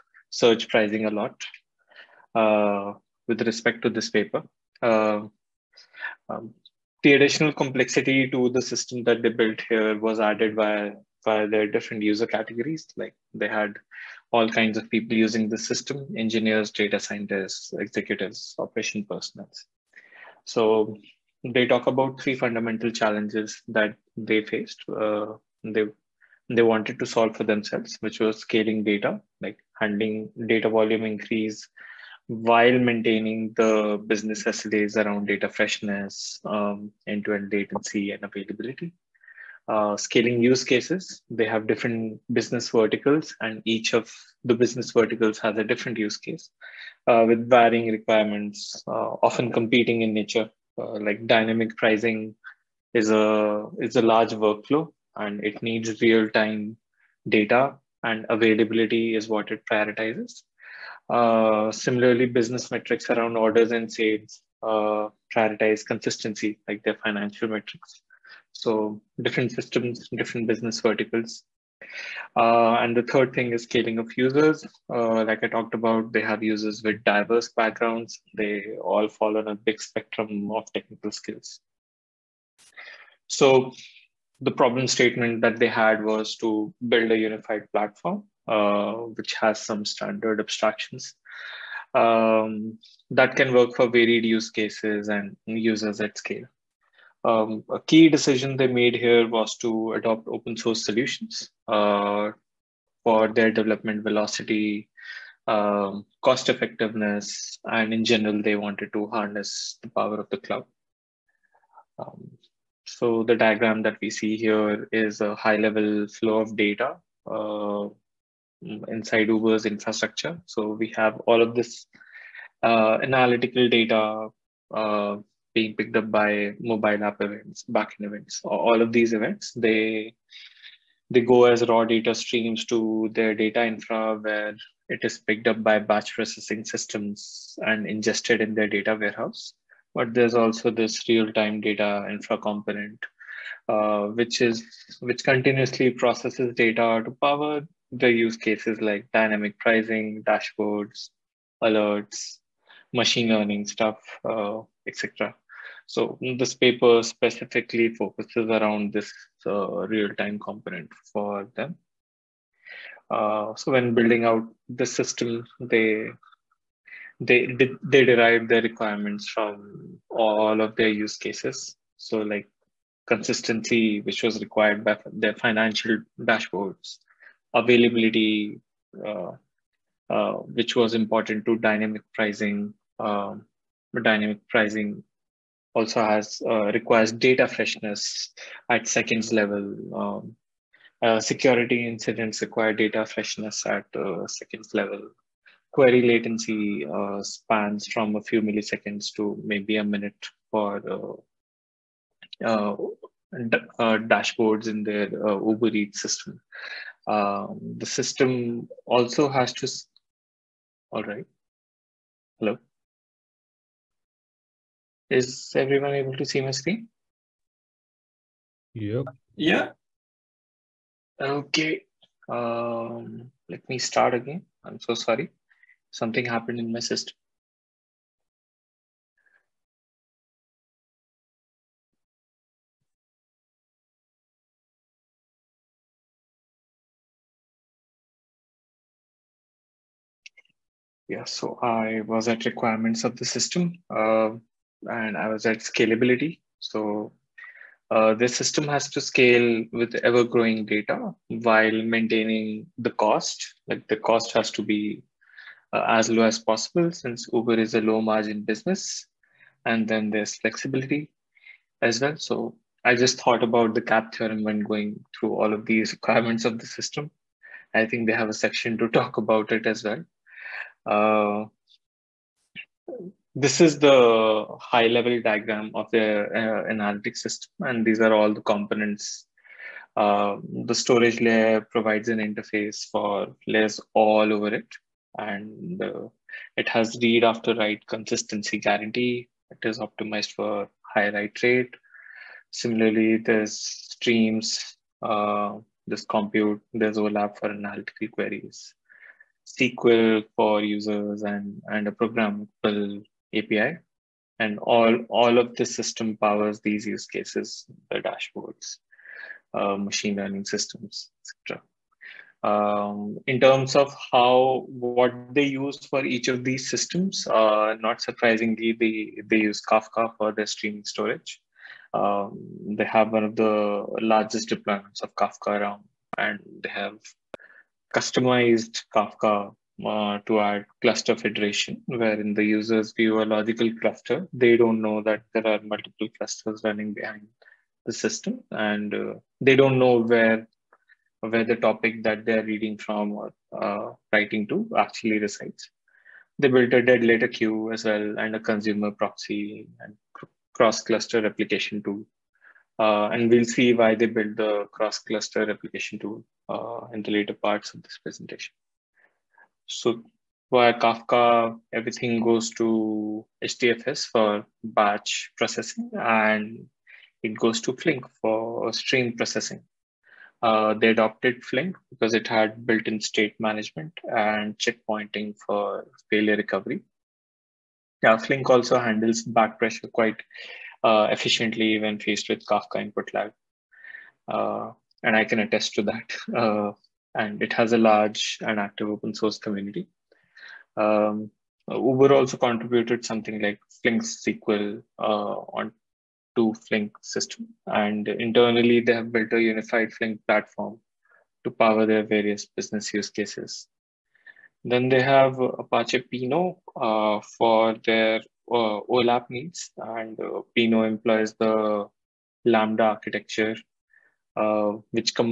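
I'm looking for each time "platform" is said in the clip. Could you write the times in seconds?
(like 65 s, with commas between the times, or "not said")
87 s, 400 s.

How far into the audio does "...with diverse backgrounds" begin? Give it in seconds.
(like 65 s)
76 s.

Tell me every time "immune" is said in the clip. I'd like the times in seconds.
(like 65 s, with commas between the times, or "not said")
not said.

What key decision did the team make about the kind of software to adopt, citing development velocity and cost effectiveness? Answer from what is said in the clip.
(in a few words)
Open source solutions.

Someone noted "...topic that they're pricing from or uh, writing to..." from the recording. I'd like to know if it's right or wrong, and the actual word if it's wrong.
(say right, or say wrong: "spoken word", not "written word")
wrong: "reading", not "pricing".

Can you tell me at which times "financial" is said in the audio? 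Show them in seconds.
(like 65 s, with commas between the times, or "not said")
67 s, 175 s.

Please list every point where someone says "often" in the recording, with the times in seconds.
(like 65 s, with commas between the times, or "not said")
49 s.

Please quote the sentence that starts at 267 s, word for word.
I think they have a section to talk about it as well.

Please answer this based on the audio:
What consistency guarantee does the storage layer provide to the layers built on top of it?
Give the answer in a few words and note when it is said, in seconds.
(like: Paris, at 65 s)
Read after write, at 287 s.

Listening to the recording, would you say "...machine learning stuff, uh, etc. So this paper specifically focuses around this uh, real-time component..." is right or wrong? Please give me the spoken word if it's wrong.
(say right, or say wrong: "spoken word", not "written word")
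right.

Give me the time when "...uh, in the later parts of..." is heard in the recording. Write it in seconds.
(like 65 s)
356 s.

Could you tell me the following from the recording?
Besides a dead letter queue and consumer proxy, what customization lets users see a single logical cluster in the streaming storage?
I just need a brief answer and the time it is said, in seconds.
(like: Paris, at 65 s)
Cluster federation, at 330 s.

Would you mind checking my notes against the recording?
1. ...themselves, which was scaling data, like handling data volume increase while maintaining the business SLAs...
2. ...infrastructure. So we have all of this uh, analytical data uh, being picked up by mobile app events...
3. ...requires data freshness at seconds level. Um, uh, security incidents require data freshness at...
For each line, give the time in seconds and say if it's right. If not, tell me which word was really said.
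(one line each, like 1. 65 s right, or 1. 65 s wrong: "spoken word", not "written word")
1. 27 s right
2. 119 s right
3. 186 s right.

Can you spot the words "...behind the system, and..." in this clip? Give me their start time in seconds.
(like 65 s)
336 s.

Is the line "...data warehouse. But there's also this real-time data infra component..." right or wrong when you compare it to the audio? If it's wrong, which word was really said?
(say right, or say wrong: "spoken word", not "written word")
right.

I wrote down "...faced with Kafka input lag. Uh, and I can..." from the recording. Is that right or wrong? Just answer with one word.
right.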